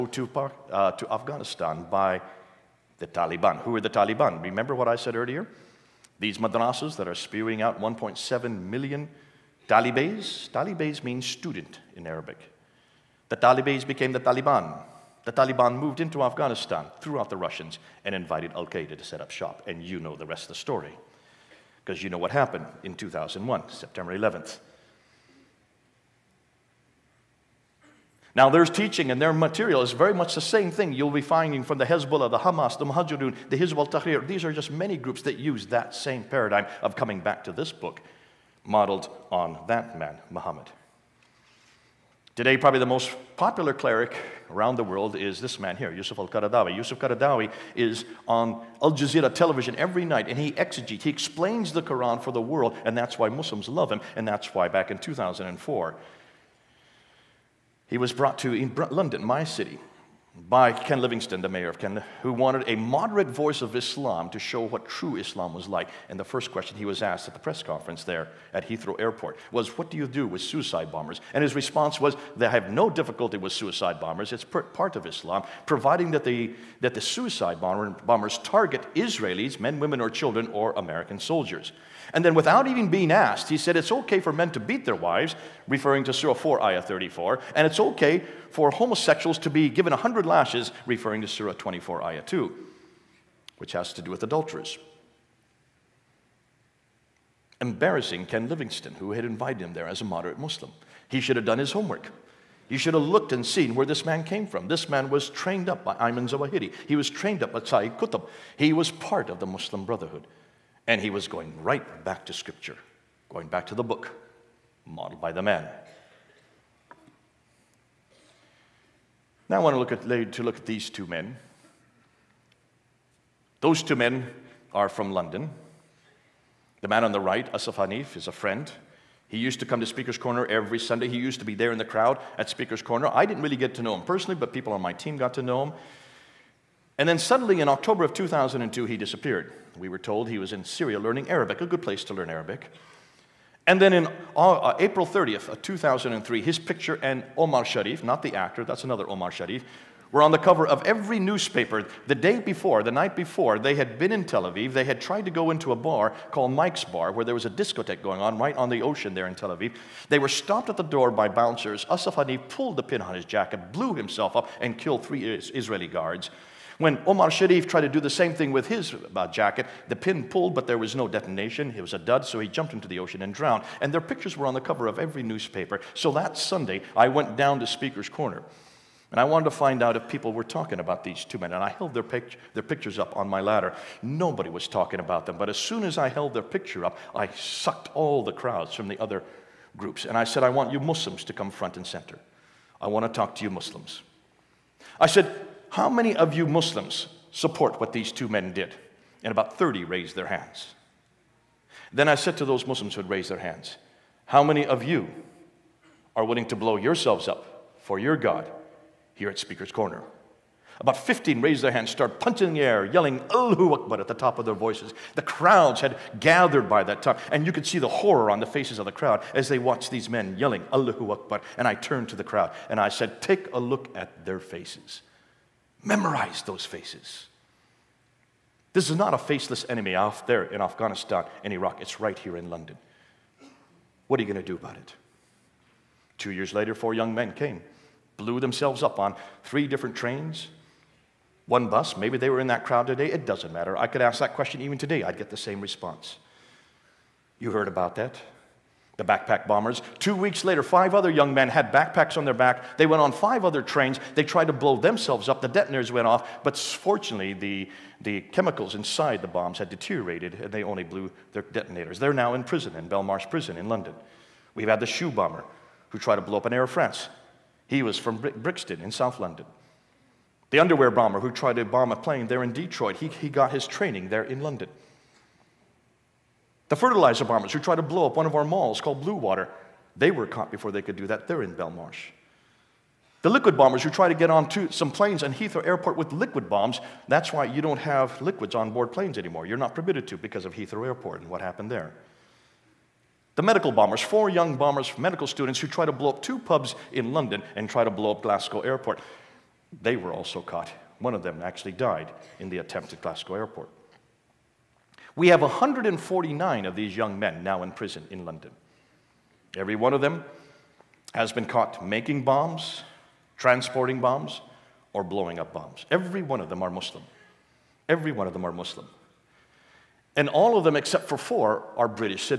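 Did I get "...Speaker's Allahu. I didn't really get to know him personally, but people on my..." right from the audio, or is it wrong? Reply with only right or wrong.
wrong.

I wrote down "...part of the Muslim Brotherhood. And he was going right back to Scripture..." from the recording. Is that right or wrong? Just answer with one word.
right.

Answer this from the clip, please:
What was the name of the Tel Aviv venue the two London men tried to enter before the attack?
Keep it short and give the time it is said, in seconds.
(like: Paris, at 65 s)
Mike's Bar, at 156 s.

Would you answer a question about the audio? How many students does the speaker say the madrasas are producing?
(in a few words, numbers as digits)
1.7 million.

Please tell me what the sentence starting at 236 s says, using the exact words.
Two years later, four young men came, blew themselves up on three different trains, one bus.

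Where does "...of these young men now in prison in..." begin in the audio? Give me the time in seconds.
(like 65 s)
306 s.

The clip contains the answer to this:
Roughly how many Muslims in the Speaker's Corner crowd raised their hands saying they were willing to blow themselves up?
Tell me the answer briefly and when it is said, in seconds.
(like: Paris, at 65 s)
15, at 210 s.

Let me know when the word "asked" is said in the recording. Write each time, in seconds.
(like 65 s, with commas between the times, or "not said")
67 s, 83 s.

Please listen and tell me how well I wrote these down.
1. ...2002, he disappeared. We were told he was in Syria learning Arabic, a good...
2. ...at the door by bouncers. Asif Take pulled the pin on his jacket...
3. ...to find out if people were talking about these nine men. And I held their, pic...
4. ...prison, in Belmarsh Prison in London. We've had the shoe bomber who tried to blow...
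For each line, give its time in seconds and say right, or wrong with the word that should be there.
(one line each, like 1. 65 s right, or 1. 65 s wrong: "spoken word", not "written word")
1. 138 s right
2. 160 s wrong: "Hanif", not "Take"
3. 179 s wrong: "two", not "nine"
4. 262 s right.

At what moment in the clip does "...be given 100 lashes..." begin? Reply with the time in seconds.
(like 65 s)
89 s.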